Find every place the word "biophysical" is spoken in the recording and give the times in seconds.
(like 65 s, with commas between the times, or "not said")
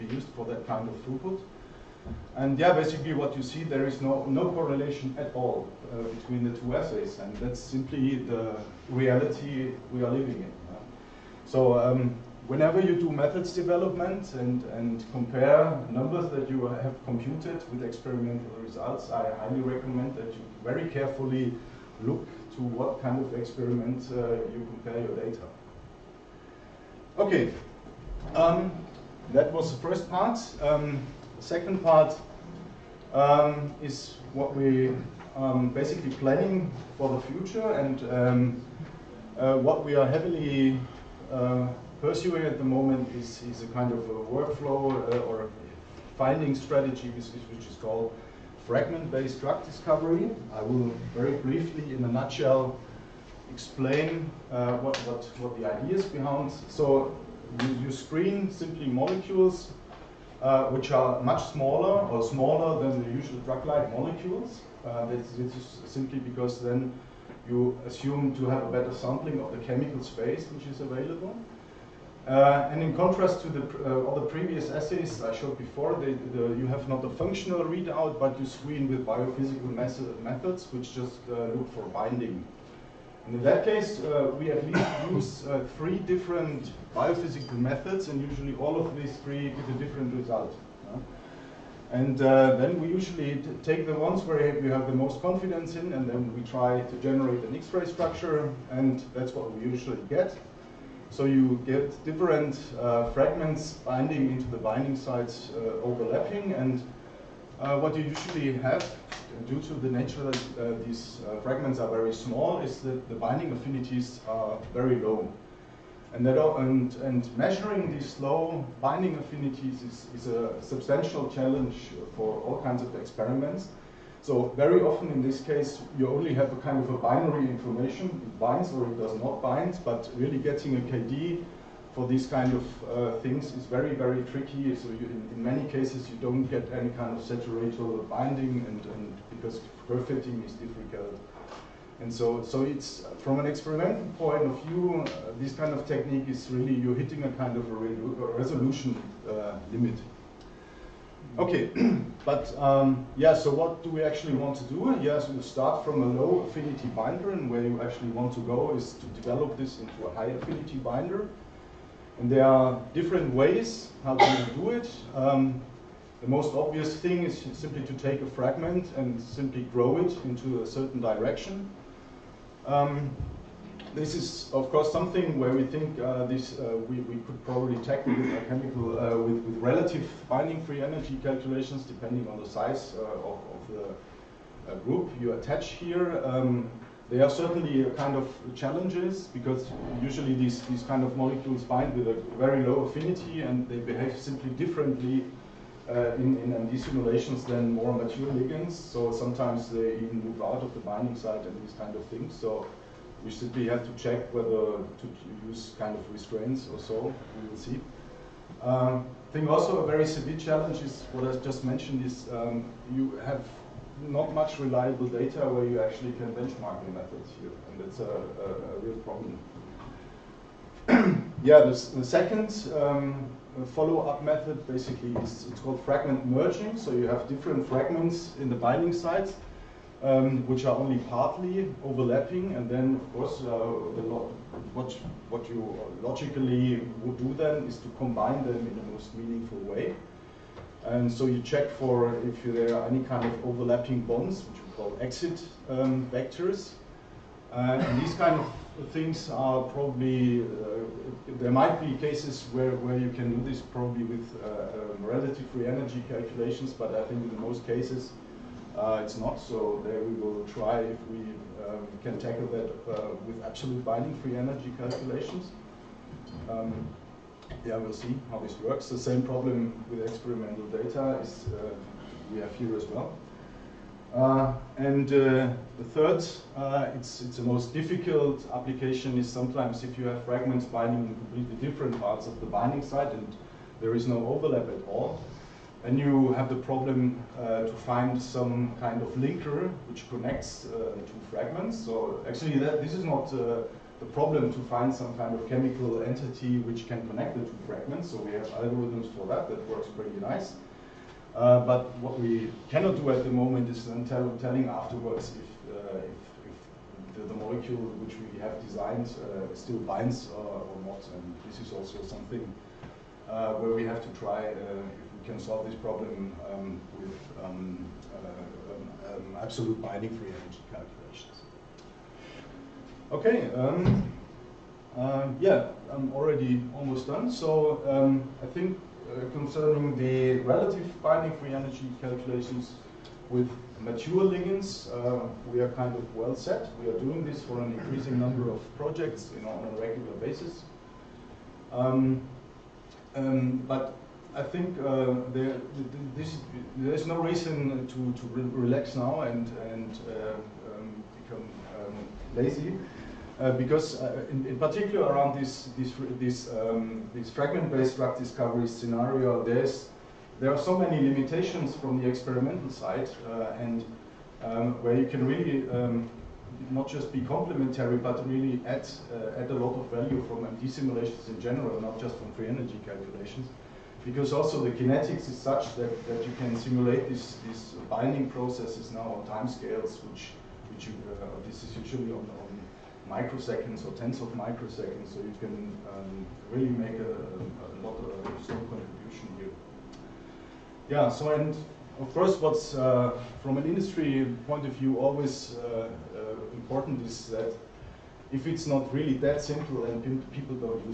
79 s, 86 s.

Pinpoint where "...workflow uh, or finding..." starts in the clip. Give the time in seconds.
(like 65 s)
44 s.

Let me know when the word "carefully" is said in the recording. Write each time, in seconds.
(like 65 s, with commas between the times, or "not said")
20 s.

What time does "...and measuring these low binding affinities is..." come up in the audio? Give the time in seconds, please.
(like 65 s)
116 s.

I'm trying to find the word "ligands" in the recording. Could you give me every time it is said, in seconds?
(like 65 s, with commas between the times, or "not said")
198 s, 334 s.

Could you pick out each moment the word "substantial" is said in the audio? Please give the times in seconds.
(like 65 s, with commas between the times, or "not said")
120 s.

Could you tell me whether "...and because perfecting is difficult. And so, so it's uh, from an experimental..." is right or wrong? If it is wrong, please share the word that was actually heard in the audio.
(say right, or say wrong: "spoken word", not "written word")
right.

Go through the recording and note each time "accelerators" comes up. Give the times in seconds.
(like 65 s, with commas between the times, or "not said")
not said.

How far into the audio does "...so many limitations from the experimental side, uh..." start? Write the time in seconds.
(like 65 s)
360 s.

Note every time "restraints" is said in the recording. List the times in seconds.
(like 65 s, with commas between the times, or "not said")
206 s.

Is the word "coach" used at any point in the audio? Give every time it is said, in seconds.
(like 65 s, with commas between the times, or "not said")
not said.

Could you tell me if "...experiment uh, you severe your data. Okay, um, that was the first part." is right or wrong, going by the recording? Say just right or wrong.
wrong.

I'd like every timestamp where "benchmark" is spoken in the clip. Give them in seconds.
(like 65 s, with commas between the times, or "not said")
216 s.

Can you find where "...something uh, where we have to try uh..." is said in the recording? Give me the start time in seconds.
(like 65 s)
312 s.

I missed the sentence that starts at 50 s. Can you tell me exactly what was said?
I will very briefly, in a nutshell, explain uh, what, what, what the is behind.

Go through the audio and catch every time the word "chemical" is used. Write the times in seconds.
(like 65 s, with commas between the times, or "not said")
69 s, 178 s, 295 s.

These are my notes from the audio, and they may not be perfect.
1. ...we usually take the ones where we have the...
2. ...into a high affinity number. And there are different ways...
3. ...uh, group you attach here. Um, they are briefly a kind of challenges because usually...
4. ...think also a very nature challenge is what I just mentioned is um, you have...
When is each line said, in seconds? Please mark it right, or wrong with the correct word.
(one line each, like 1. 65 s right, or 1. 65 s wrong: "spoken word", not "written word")
1. 92 s right
2. 159 s wrong: "binder", not "number"
3. 184 s wrong: "certainly", not "briefly"
4. 209 s wrong: "severe", not "nature".